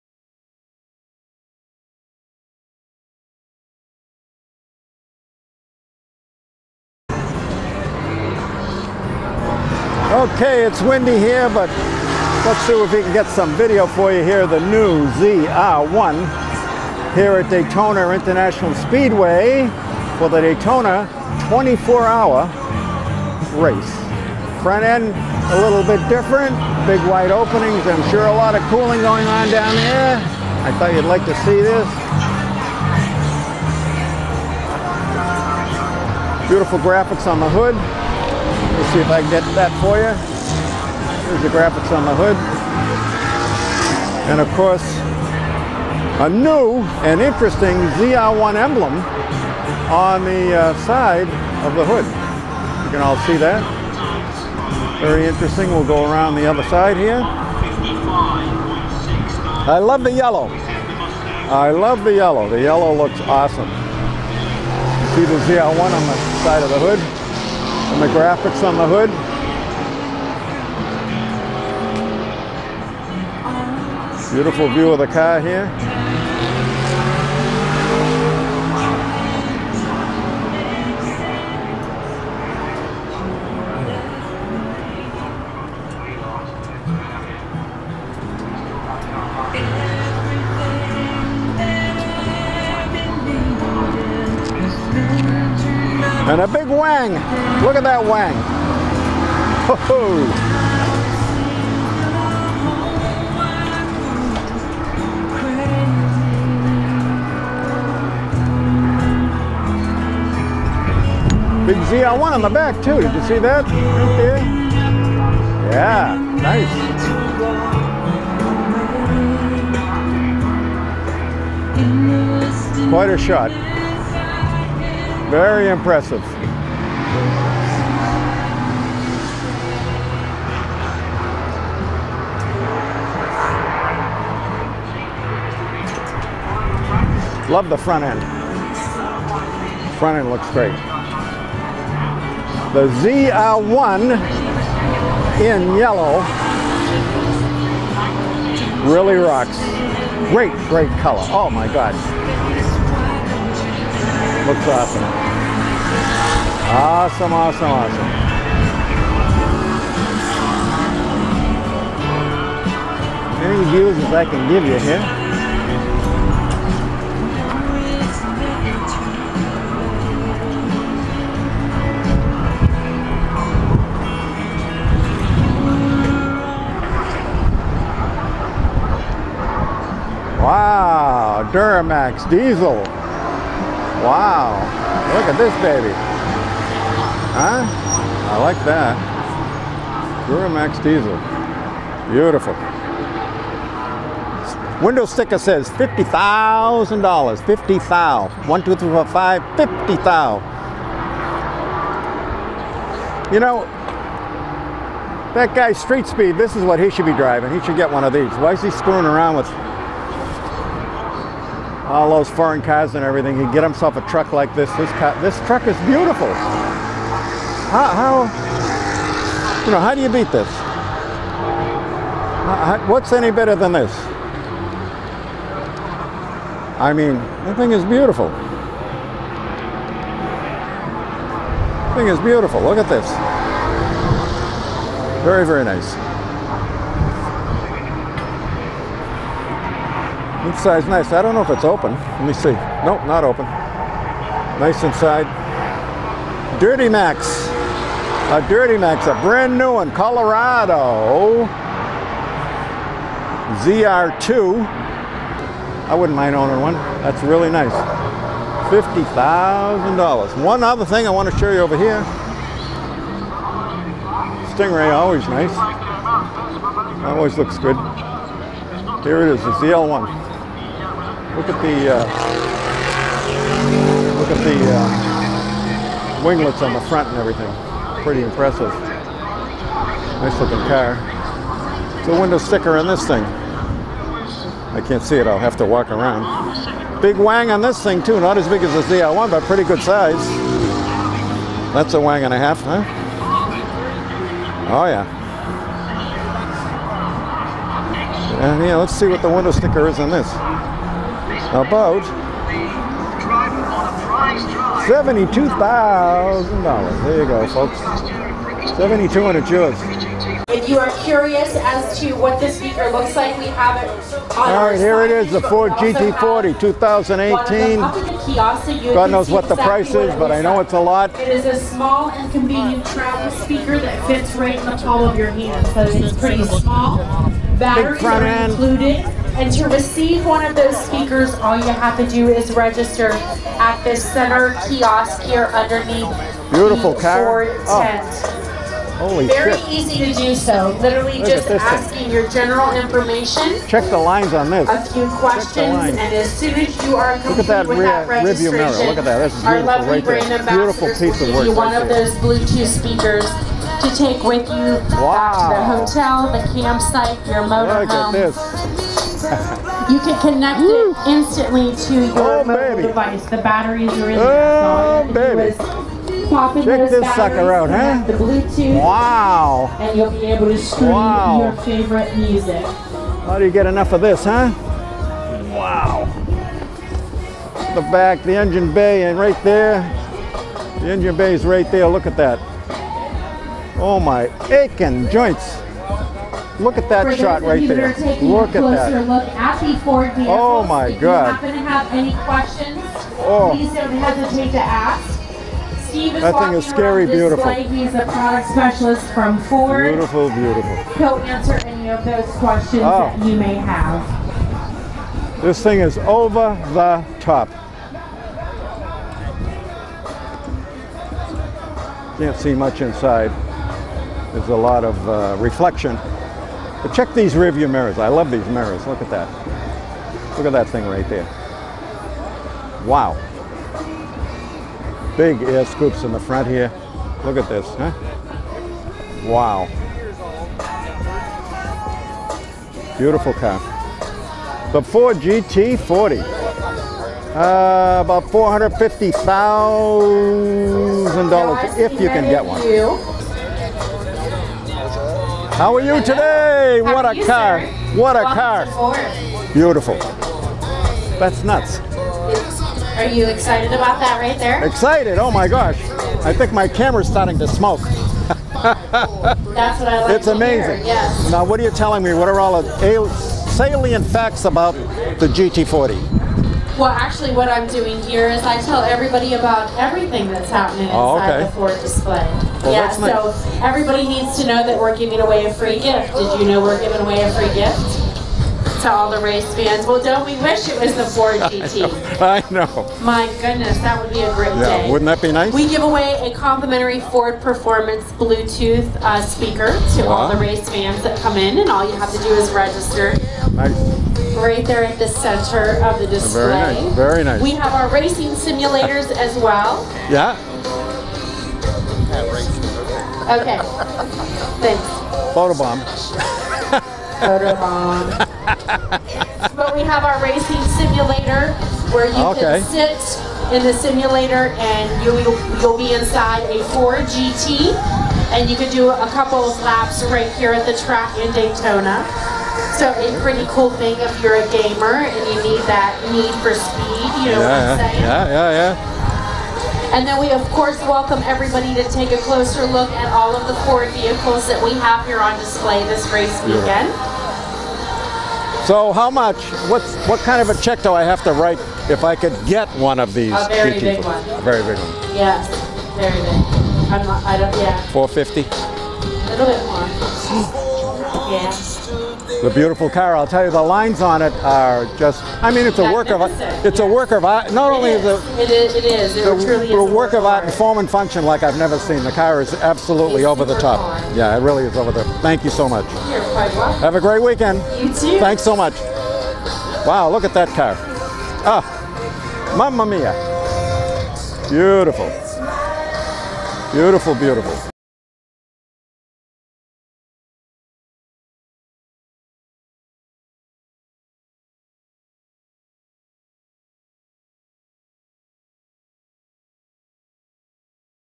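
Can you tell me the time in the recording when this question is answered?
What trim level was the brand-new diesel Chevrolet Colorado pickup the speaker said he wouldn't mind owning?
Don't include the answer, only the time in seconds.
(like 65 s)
253 s.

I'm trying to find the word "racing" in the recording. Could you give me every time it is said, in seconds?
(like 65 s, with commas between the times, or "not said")
497 s, 510 s.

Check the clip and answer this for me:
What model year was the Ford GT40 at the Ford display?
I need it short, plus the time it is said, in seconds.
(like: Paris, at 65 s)
2018, at 315 s.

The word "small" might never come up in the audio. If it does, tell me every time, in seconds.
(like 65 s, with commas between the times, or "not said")
321 s, 326 s.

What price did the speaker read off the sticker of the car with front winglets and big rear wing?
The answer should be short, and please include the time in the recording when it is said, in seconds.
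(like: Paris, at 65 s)
$72,000, at 304 s.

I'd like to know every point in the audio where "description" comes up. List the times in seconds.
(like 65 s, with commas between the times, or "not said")
not said.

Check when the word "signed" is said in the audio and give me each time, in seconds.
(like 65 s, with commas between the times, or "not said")
not said.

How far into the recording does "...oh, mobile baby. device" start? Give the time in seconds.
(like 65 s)
362 s.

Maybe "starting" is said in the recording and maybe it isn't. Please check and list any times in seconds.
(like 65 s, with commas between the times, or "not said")
457 s.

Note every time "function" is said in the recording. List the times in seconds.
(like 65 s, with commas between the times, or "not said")
560 s.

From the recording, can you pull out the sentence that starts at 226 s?
I mean, the thing is beautiful.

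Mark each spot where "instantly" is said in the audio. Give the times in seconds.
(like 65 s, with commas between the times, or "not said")
361 s.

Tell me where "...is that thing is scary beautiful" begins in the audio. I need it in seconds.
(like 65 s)
396 s.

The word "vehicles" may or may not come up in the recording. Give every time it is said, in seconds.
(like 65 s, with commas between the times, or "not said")
390 s, 533 s.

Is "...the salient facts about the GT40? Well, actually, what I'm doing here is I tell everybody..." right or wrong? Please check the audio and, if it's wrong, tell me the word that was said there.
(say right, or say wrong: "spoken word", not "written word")
right.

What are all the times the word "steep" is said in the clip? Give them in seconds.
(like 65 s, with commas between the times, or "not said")
not said.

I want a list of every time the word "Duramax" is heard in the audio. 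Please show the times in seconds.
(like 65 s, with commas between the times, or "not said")
181 s, 190 s.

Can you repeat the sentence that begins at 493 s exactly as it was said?
Nice right there at the center of the display.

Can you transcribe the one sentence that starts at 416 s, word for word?
But check these rear view mirrors.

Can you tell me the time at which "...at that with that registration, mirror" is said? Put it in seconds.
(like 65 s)
347 s.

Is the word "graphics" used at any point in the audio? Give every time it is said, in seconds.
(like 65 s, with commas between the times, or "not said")
36 s, 41 s, 68 s.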